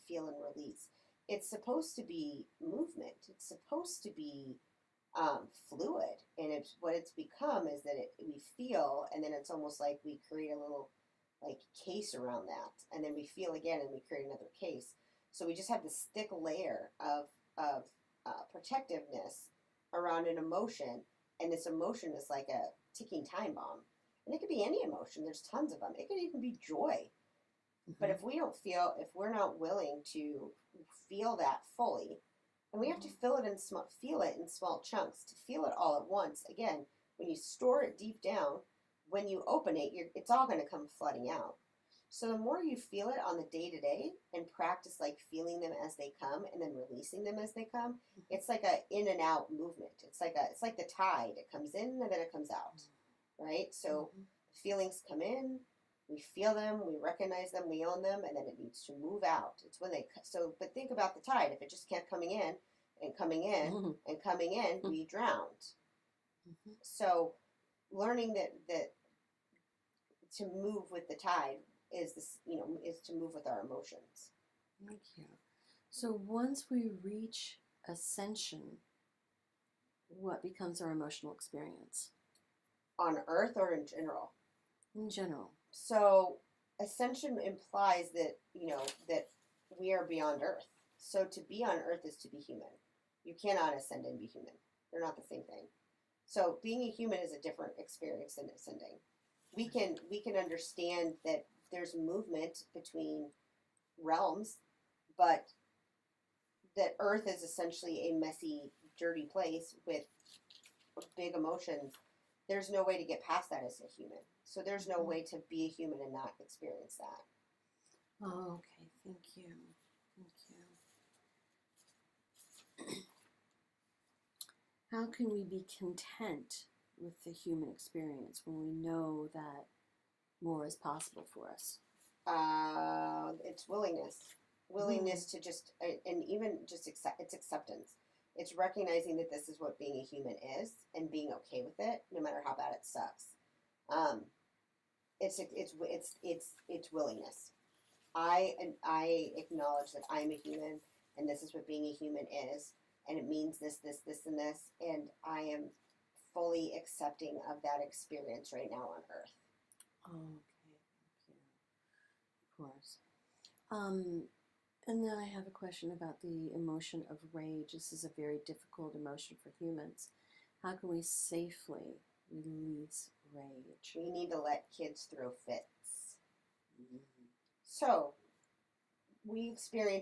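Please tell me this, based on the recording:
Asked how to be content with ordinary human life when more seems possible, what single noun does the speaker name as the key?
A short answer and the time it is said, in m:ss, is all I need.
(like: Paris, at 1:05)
acceptance, at 2:17.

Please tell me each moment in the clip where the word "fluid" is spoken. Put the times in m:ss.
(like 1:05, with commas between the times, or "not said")
0:05.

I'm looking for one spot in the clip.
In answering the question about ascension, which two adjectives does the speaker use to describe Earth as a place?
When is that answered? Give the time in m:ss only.
1:48.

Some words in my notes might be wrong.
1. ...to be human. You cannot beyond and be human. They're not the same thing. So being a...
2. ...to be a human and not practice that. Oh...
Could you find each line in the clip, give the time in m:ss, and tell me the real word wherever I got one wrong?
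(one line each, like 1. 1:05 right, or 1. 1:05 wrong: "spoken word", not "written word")
1. 1:32 wrong: "ascend", not "beyond"
2. 1:55 wrong: "experience", not "practice".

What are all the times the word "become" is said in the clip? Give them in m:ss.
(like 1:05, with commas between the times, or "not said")
0:07, 1:20.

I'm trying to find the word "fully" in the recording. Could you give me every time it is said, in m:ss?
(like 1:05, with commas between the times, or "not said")
0:31, 2:36.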